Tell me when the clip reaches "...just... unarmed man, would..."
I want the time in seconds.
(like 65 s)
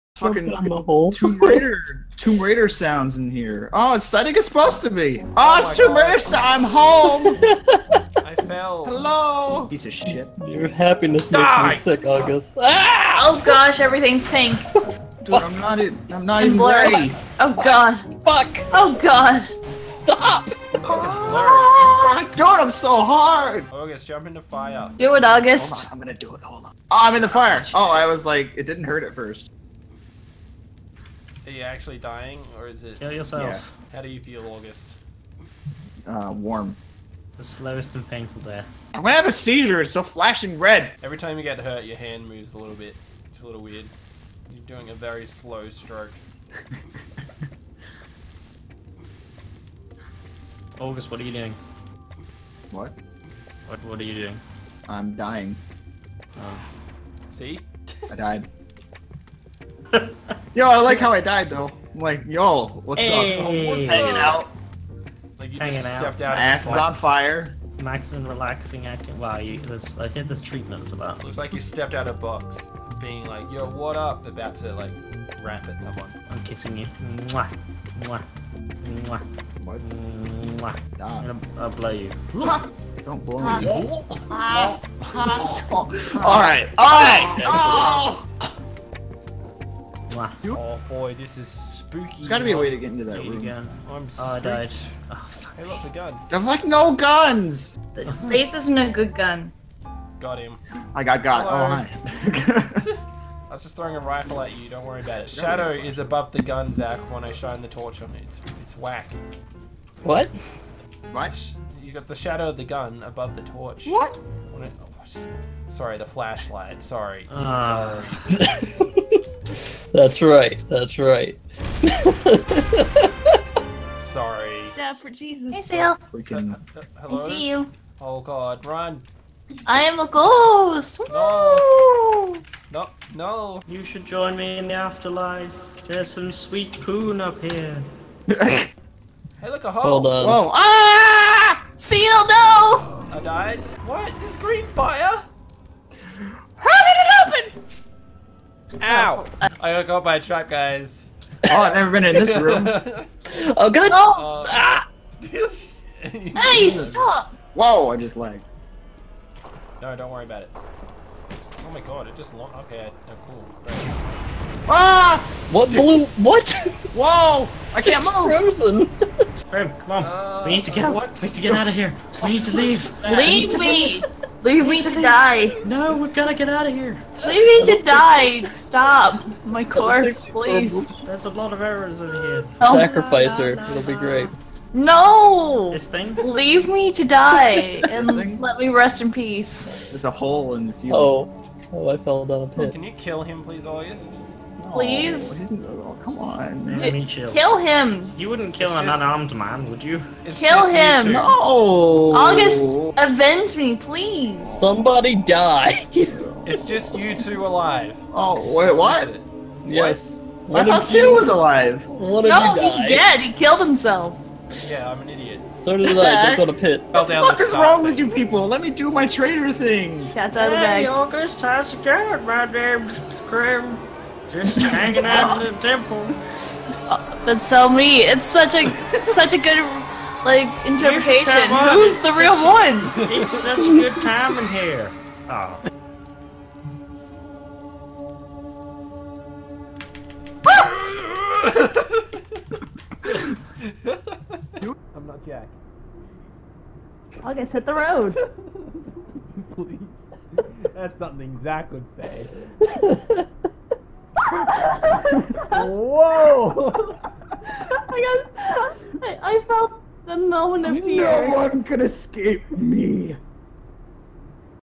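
198 s.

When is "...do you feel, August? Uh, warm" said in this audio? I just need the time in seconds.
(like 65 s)
34 s.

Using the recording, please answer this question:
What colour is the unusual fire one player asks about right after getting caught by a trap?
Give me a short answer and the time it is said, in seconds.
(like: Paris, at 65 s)
Green, at 144 s.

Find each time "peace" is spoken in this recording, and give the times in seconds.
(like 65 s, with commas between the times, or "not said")
189 s.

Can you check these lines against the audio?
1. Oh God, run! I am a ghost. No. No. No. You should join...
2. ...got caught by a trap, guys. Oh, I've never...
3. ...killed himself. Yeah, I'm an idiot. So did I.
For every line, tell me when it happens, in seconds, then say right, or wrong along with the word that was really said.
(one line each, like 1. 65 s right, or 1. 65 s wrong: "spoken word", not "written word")
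1. 128 s right
2. 149 s right
3. 213 s right.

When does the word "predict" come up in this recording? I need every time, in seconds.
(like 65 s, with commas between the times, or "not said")
not said.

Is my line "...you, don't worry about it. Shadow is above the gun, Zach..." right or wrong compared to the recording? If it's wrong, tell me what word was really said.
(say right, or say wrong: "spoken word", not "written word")
right.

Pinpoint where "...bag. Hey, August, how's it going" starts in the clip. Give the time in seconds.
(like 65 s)
220 s.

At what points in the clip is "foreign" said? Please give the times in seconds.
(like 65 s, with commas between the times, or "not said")
not said.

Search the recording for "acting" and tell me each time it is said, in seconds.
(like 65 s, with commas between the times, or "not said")
68 s.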